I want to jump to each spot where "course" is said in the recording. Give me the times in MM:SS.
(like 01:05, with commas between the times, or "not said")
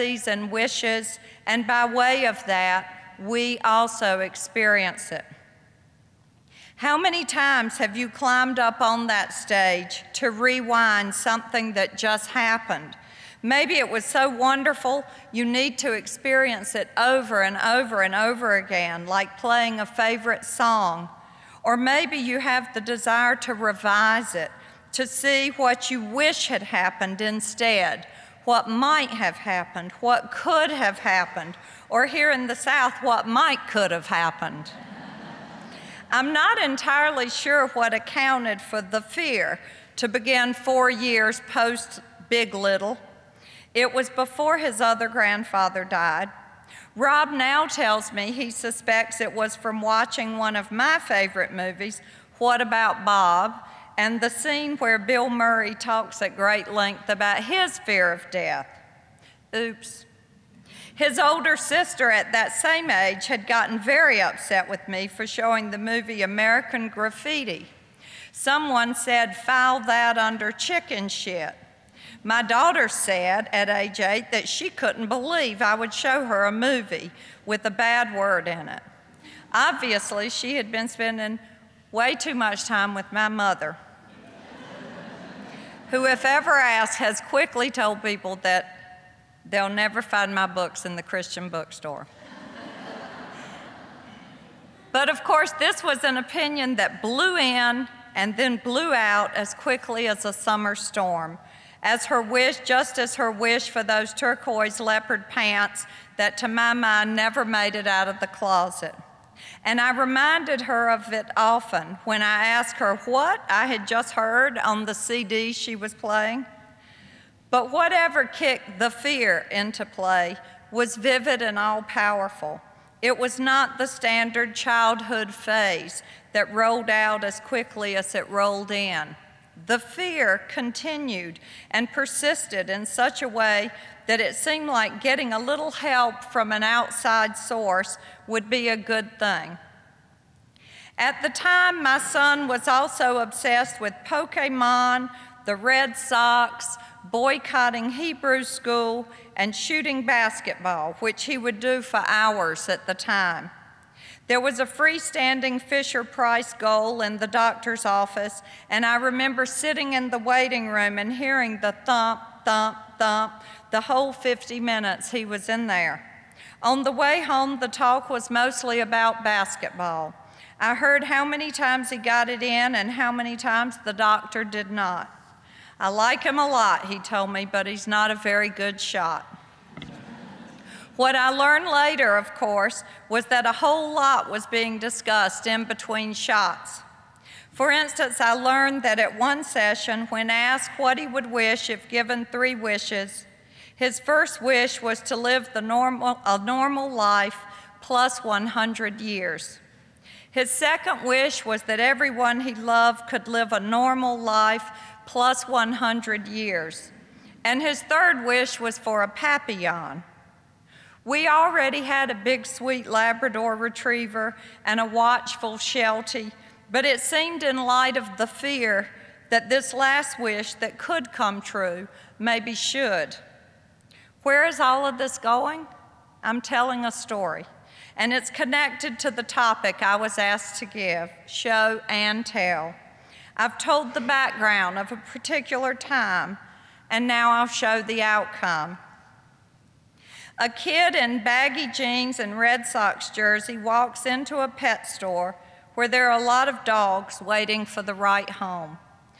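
01:35, 03:02.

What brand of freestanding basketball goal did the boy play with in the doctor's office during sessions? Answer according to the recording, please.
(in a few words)
Fisher Price.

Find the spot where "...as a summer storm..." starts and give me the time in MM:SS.
01:40.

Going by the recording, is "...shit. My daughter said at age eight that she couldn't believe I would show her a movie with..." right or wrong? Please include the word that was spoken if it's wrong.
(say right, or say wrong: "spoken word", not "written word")
right.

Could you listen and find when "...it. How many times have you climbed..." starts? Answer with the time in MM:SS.
00:05.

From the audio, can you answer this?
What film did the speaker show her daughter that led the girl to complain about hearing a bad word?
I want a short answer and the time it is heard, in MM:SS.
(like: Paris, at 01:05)
American Graffiti, at 01:06.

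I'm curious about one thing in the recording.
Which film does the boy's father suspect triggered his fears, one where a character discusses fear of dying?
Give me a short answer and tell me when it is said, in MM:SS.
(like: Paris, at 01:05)
What About Bob, at 00:52.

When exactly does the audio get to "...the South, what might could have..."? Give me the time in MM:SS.
00:32.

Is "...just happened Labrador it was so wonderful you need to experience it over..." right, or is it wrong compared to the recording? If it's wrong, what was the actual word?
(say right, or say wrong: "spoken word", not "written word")
wrong: "Maybe", not "Labrador".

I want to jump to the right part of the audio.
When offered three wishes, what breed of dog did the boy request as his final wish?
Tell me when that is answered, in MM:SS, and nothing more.
03:29.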